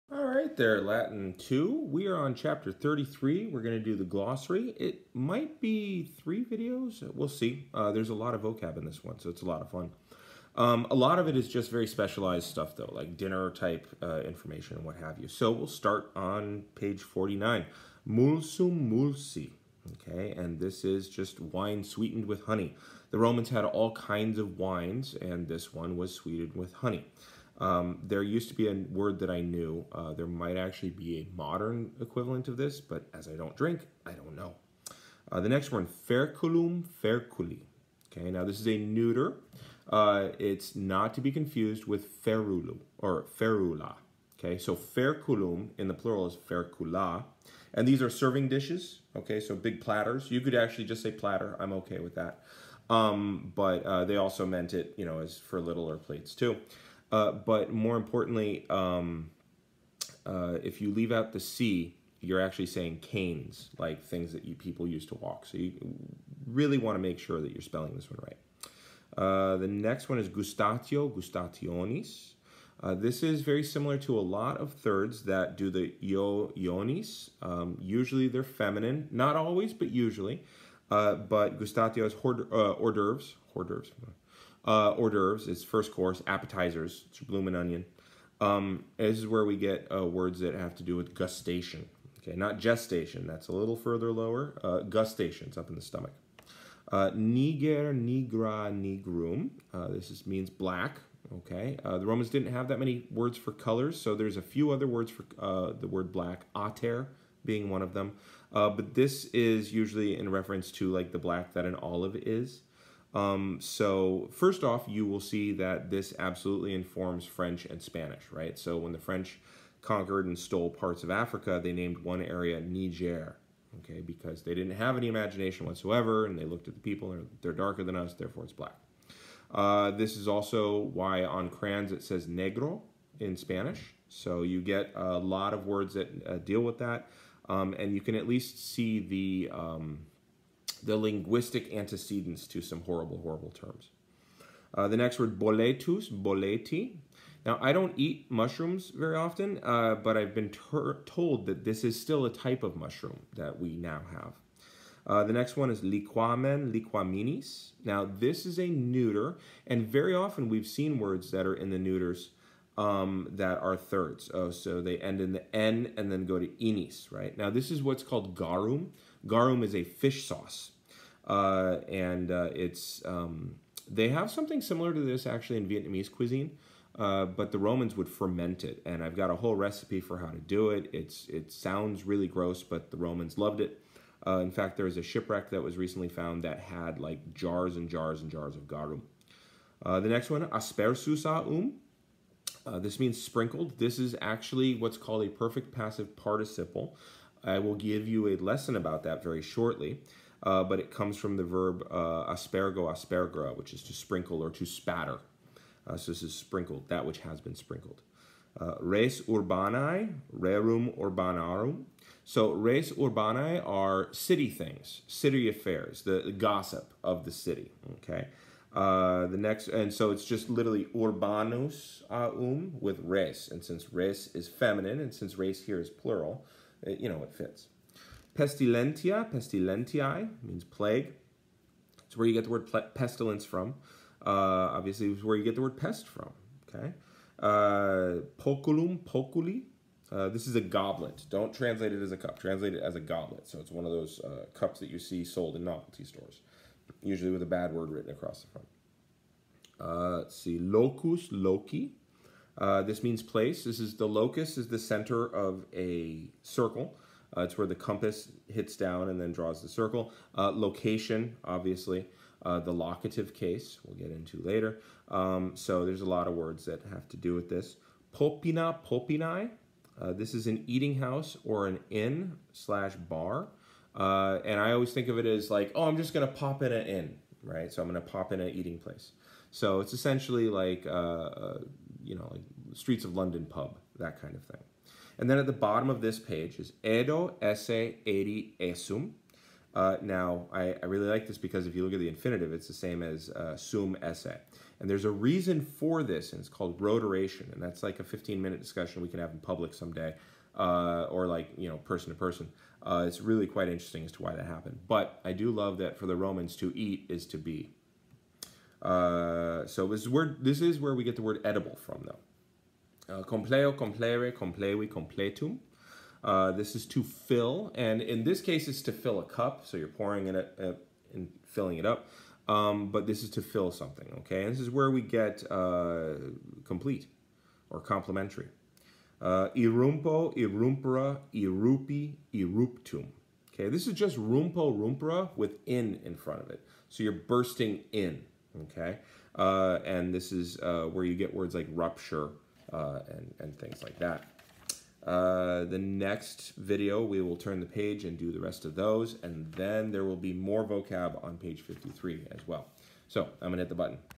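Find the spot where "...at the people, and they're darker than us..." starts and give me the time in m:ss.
2:06.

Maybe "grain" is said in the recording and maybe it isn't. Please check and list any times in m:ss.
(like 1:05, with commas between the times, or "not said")
not said.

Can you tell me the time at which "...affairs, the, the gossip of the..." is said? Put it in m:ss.
3:35.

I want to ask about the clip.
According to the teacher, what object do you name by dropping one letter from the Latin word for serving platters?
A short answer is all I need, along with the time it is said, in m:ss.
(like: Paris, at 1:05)
canes, at 1:03.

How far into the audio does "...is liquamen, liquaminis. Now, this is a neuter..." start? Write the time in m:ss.
2:35.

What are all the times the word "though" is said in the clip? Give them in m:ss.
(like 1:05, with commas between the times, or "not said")
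0:12, 5:12.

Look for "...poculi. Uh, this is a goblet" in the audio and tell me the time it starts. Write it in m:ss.
3:58.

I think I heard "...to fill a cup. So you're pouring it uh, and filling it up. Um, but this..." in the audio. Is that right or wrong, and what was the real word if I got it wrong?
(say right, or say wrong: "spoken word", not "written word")
right.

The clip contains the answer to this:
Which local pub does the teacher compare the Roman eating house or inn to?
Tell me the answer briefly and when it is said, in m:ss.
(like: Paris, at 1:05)
Streets of London, at 4:42.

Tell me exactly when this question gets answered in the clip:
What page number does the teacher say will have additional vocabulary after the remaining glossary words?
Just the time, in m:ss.
5:51.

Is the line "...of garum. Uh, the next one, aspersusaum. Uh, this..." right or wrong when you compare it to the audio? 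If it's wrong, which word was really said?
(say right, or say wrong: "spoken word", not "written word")
right.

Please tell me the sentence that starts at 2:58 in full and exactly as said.
And I've got a whole recipe for how to do it.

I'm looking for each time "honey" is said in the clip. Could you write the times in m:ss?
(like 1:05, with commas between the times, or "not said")
0:22, 0:26.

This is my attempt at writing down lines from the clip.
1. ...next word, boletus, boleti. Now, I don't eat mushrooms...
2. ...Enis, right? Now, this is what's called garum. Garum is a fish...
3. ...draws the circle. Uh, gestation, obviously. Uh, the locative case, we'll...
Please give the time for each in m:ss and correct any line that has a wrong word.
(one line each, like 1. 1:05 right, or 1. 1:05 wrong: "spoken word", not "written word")
1. 2:24 right
2. 2:46 right
3. 4:19 wrong: "location", not "gestation".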